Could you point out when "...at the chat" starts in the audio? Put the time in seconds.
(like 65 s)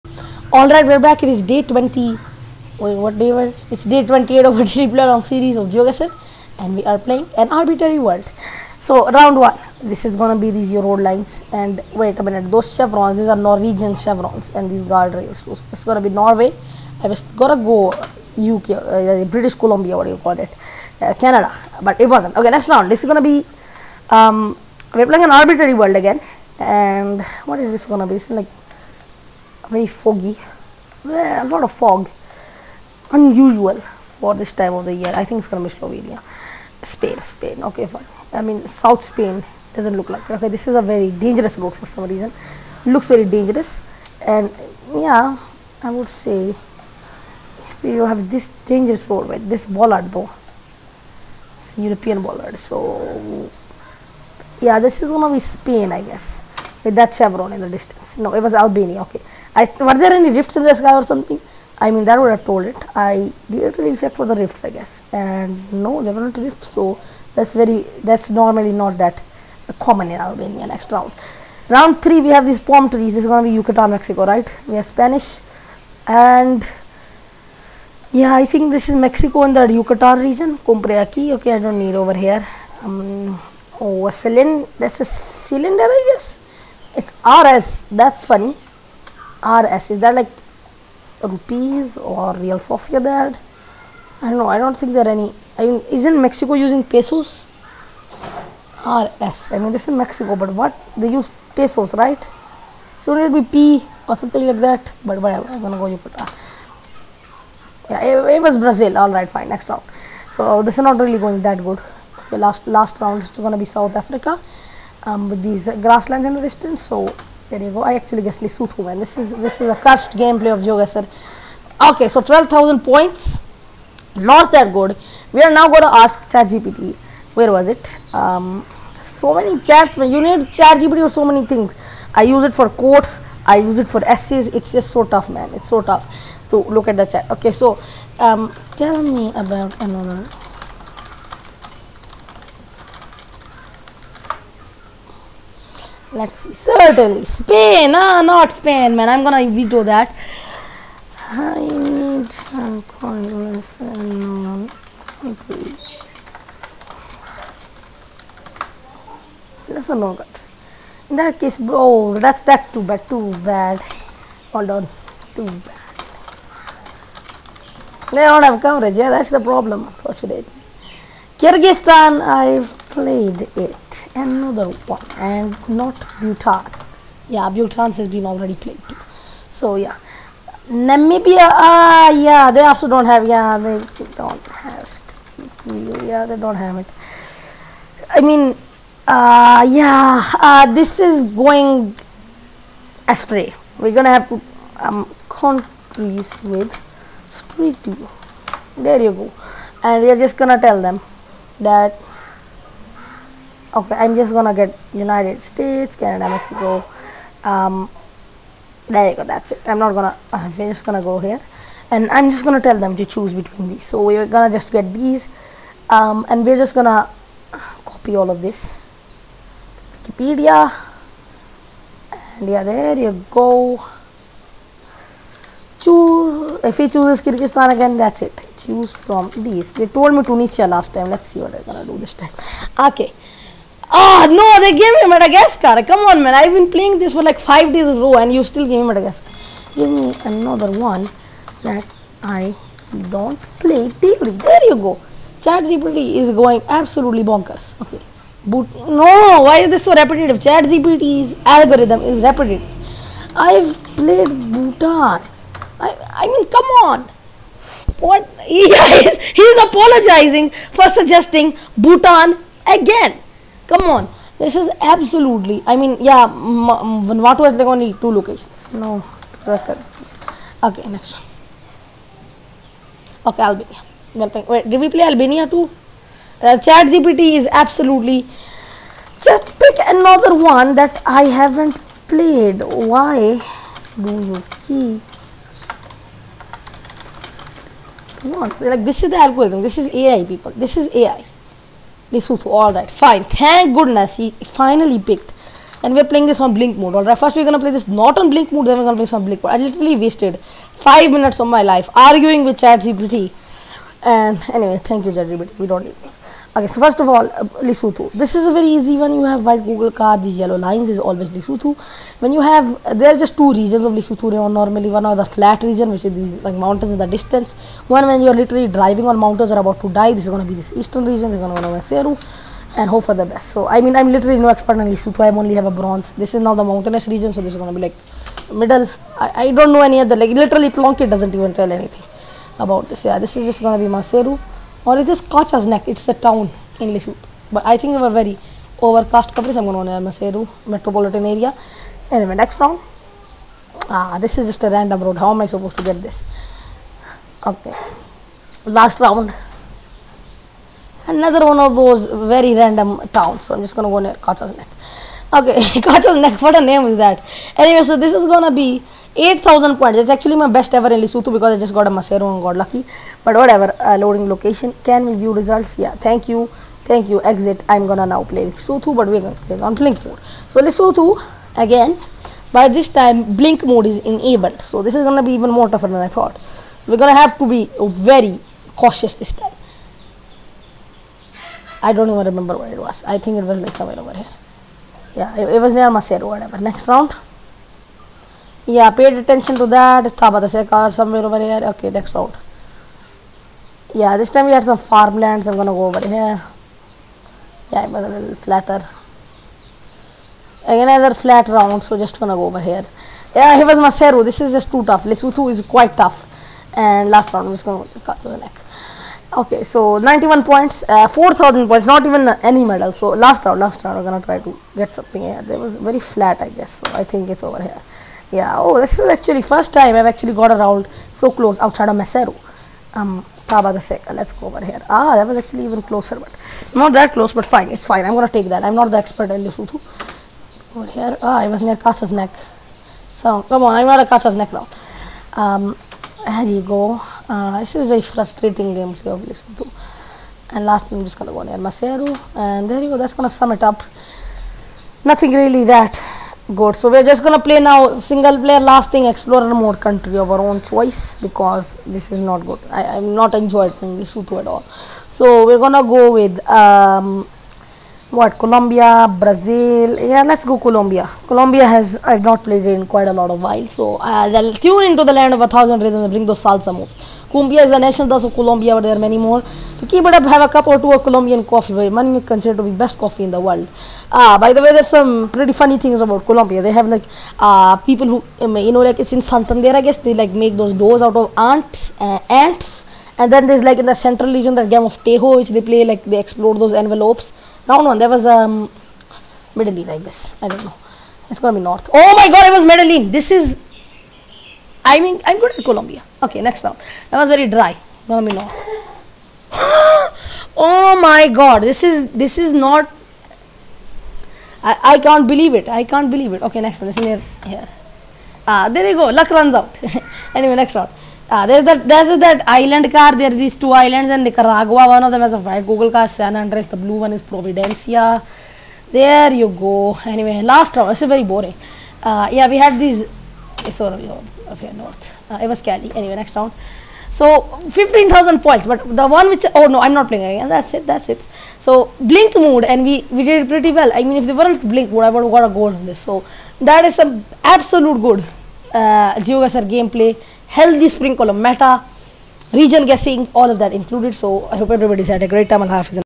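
136 s.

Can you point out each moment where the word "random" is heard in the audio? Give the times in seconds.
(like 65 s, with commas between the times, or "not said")
344 s, 352 s.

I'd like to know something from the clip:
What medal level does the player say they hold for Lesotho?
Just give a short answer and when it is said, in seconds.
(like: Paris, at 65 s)
Bronze, at 325 s.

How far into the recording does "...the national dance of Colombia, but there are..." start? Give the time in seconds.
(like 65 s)
467 s.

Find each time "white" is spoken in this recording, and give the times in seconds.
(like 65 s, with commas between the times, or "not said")
309 s, 515 s.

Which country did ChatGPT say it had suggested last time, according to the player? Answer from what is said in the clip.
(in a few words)
Tunisia.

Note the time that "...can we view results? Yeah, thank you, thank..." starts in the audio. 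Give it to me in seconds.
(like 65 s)
364 s.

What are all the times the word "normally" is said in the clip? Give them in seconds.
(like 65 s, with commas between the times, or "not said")
68 s, 314 s.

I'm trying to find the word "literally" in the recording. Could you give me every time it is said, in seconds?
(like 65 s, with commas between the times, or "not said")
299 s, 318 s, 324 s, 330 s.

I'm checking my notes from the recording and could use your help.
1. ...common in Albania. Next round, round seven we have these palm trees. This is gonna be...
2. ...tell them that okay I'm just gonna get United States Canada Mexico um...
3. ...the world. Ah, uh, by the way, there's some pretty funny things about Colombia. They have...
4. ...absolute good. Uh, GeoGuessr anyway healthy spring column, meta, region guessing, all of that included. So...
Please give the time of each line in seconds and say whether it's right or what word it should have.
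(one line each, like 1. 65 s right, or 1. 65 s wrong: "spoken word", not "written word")
1. 69 s wrong: "three", not "seven"
2. 200 s right
3. 473 s right
4. 537 s wrong: "gameplay", not "anyway".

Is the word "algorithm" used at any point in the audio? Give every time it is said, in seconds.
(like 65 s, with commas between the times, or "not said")
251 s, 289 s.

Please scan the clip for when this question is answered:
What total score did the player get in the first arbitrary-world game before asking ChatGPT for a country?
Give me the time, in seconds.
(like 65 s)
122 s.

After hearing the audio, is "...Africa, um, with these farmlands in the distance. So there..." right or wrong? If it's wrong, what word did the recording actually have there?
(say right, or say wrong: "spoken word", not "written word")
wrong: "grasslands", not "farmlands".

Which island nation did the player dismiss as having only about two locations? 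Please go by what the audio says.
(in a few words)
Vanuatu.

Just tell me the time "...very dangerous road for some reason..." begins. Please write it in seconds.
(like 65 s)
40 s.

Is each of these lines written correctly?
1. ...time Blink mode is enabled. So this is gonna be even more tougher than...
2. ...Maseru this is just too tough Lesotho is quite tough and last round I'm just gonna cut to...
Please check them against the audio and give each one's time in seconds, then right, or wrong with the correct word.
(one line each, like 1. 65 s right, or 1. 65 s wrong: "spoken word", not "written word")
1. 372 s right
2. 403 s right.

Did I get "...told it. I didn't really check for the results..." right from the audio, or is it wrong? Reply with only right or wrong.
wrong.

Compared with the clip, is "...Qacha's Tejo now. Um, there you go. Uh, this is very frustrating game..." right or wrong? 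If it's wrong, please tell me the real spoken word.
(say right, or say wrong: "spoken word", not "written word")
wrong: "Nek", not "Tejo".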